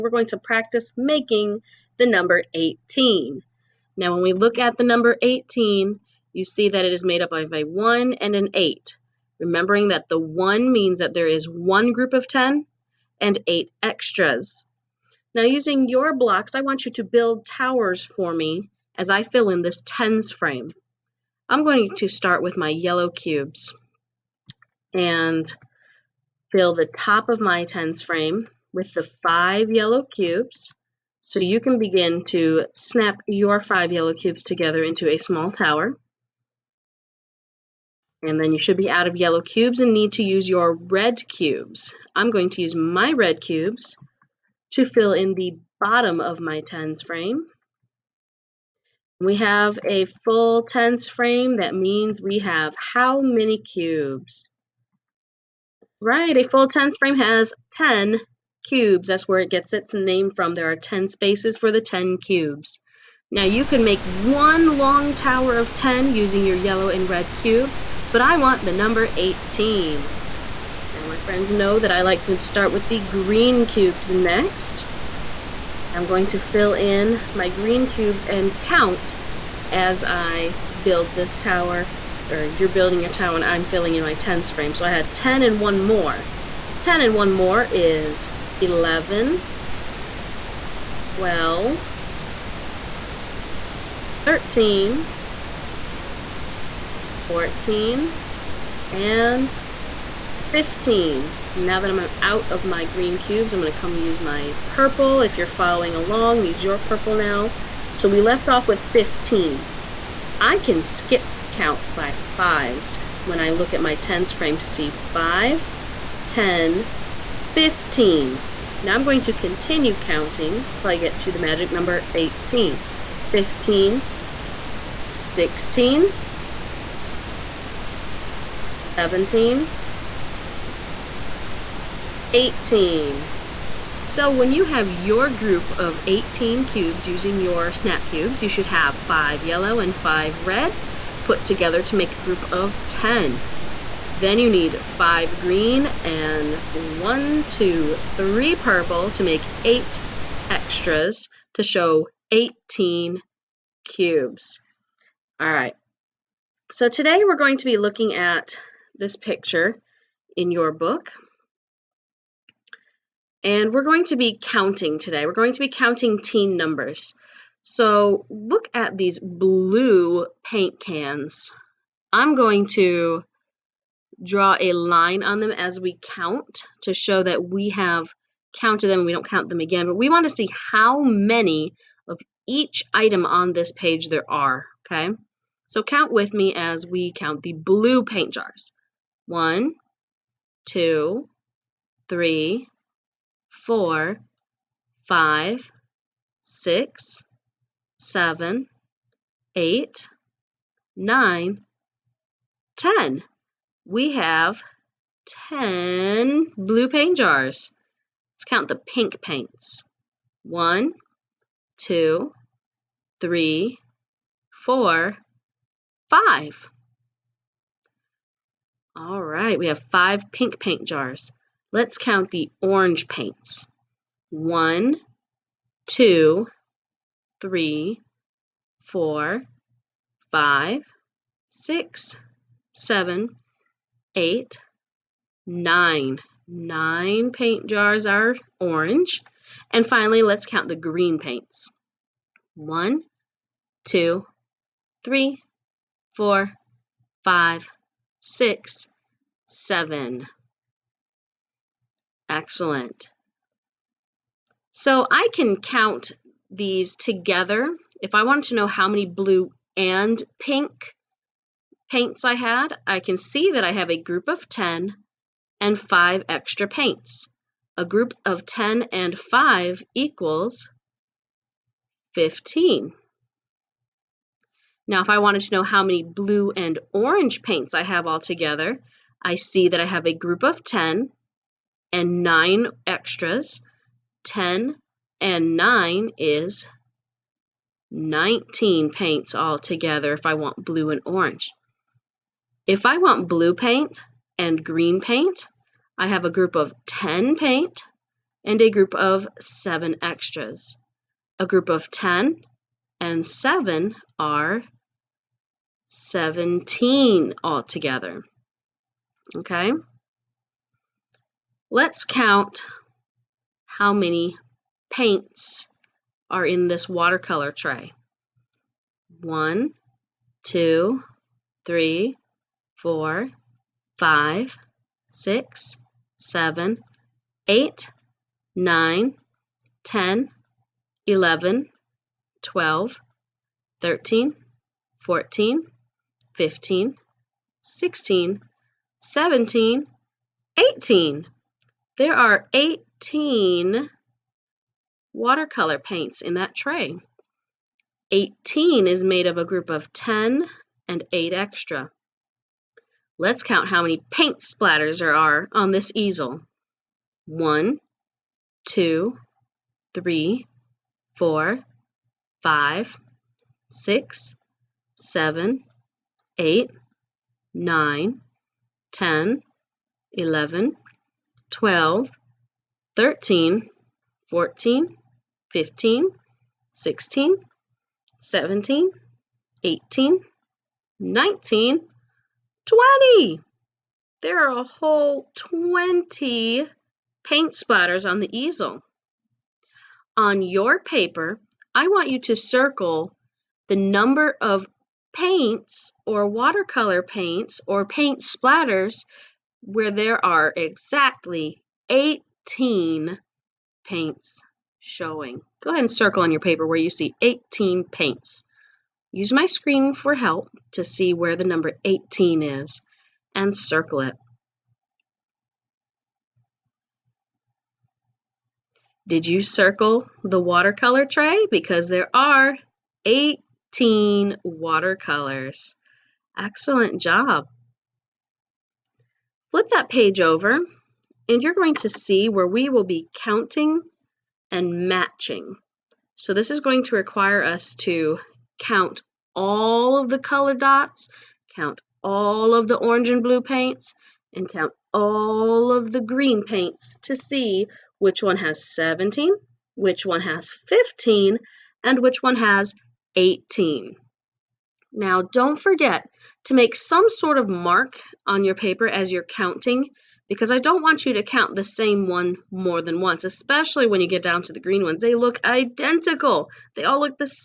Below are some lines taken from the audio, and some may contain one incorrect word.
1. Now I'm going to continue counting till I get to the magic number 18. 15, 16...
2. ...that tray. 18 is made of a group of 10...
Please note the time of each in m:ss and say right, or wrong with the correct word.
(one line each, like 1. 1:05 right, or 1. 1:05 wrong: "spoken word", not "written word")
1. 1:58 right
2. 5:46 right.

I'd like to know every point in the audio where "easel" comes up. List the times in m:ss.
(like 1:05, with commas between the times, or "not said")
5:55, 6:28.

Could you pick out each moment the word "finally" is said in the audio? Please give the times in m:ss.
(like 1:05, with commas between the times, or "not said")
3:59.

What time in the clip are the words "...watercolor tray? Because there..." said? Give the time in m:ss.
7:00.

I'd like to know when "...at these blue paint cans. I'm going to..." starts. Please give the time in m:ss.
2:48.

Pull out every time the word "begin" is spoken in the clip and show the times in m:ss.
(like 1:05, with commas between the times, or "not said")
0:31.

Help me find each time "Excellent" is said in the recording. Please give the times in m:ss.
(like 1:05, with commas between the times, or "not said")
4:12, 7:06.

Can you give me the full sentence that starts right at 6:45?
Go ahead and circle on your paper where you see 18 paints.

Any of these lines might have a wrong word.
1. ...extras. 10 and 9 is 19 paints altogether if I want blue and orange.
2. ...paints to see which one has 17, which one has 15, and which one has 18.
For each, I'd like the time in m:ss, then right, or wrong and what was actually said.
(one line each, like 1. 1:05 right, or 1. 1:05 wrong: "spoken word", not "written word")
1. 4:42 right
2. 7:26 right.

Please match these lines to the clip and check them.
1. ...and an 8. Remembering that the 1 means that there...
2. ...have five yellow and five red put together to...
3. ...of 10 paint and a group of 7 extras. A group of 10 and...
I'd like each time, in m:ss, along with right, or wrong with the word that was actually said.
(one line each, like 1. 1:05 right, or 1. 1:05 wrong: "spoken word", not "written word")
1. 0:08 right
2. 2:18 right
3. 4:56 right.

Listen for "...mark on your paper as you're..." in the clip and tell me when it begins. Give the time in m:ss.
7:37.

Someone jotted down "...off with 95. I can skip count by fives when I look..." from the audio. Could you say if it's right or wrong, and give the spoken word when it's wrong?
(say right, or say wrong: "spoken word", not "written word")
wrong: "15", not "95".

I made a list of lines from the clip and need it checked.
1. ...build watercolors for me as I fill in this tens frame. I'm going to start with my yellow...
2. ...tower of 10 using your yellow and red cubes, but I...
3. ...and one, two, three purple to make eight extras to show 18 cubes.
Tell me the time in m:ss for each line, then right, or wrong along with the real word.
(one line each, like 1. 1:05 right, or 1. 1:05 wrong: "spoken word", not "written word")
1. 0:17 wrong: "towers", not "watercolors"
2. 1:05 right
3. 2:26 right.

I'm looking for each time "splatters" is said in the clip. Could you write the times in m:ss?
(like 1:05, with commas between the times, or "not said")
5:54, 6:27, 6:38.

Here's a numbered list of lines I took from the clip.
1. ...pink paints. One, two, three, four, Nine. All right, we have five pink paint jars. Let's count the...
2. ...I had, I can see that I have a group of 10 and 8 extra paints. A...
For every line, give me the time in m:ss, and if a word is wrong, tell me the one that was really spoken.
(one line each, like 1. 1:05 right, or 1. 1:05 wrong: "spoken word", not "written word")
1. 3:28 wrong: "Five", not "Nine"
2. 4:22 wrong: "5", not "8".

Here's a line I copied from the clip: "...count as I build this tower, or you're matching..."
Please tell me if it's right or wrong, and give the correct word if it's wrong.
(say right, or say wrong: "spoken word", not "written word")
wrong: "building", not "matching".